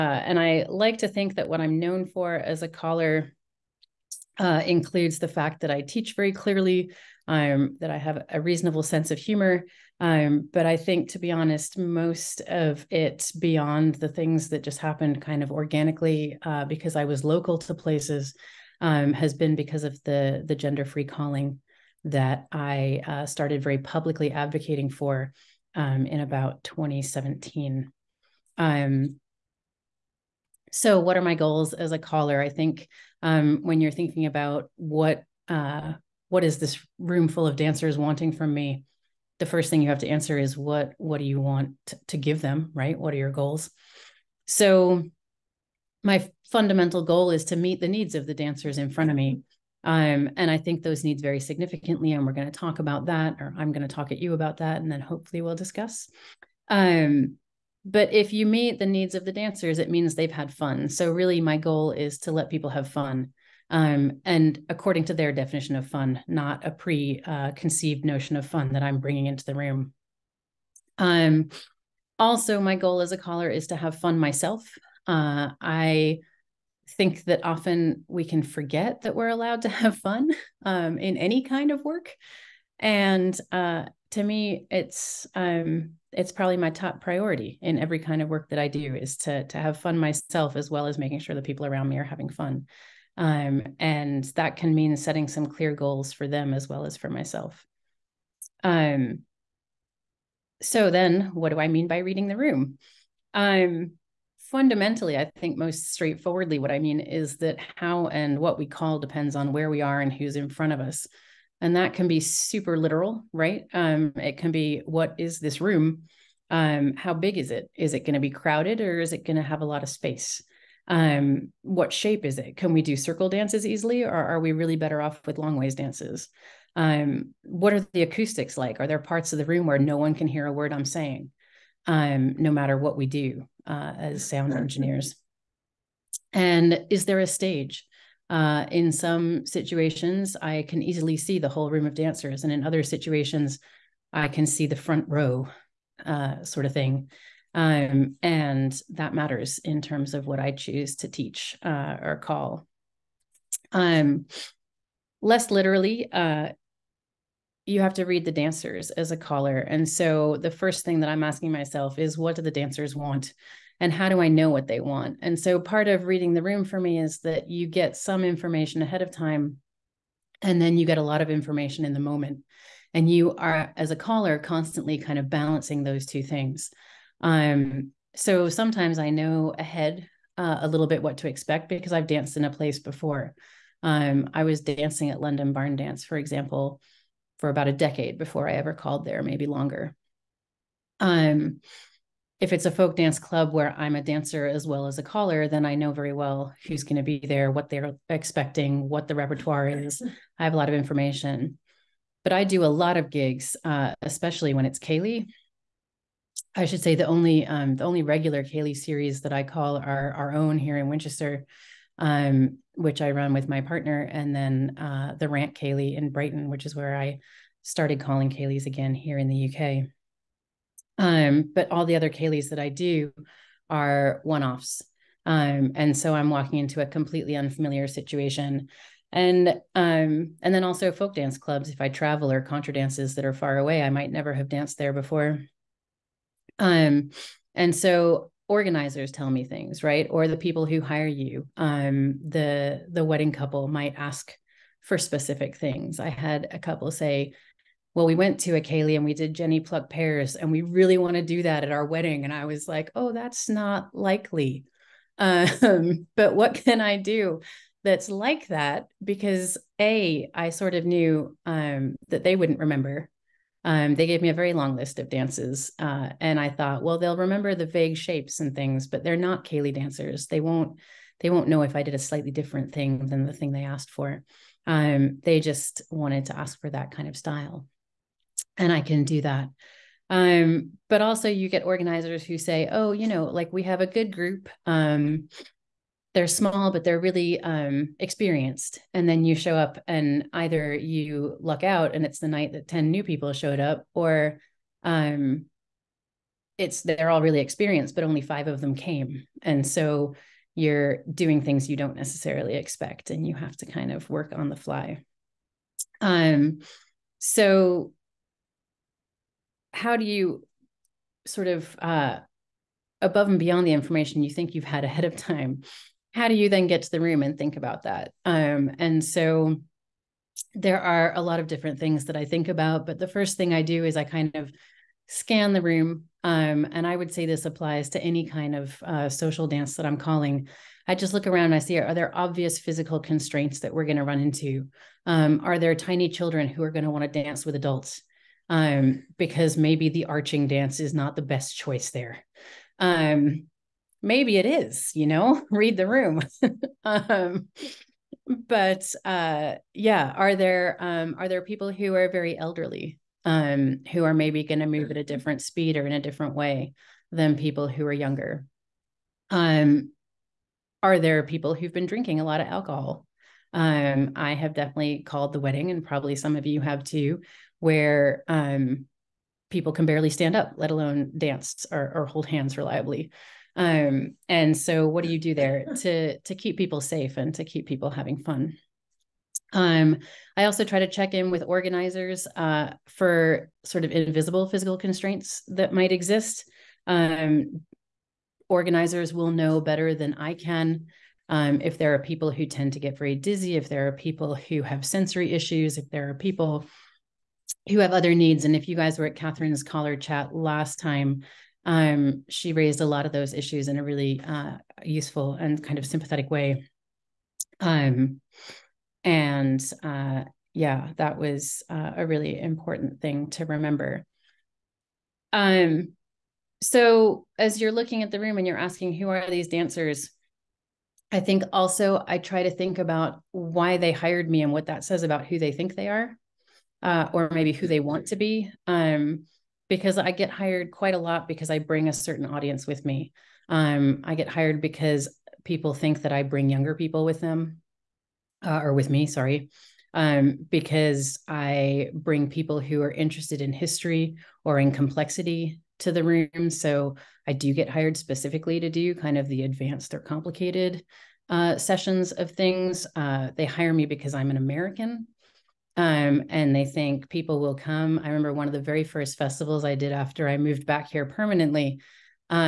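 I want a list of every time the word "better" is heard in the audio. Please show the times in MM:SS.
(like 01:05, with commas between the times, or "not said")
02:04, 06:29.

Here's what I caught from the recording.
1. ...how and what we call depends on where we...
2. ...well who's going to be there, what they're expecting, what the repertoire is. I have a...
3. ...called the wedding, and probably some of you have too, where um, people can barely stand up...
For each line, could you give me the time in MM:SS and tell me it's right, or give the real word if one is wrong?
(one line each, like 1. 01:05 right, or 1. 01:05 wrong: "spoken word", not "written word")
1. 01:47 right
2. 03:16 right
3. 06:05 right.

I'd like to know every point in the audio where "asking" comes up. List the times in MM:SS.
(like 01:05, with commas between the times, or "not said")
02:41, 06:58.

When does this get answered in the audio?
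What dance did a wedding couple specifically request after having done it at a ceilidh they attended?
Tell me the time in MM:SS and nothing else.
04:09.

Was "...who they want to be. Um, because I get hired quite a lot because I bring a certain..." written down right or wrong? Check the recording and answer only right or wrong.
right.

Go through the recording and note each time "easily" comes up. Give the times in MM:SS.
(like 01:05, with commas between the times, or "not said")
02:03, 02:20.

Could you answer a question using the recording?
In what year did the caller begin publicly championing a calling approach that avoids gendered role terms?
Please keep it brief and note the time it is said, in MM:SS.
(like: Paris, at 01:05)
2017, at 00:26.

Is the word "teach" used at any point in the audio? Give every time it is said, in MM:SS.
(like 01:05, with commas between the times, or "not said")
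00:05, 02:31.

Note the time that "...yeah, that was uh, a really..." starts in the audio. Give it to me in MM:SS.
06:50.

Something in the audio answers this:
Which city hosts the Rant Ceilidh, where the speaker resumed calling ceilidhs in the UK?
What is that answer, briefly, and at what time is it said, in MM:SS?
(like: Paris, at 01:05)
Brighton, at 03:36.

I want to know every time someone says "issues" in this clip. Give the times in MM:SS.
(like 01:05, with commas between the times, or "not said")
06:35, 06:43.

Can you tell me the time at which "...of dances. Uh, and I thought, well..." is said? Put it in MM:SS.
04:24.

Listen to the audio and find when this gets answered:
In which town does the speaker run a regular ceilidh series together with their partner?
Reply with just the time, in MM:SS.
03:30.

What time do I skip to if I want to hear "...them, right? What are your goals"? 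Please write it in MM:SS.
00:42.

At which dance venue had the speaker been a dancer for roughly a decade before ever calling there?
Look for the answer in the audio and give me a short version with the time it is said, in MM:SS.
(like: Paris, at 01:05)
London Barn Dance, at 03:05.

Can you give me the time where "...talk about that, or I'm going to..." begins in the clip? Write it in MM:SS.
00:52.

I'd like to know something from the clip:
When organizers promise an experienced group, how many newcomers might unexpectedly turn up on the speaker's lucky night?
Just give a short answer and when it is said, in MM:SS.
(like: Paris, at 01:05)
10, at 04:52.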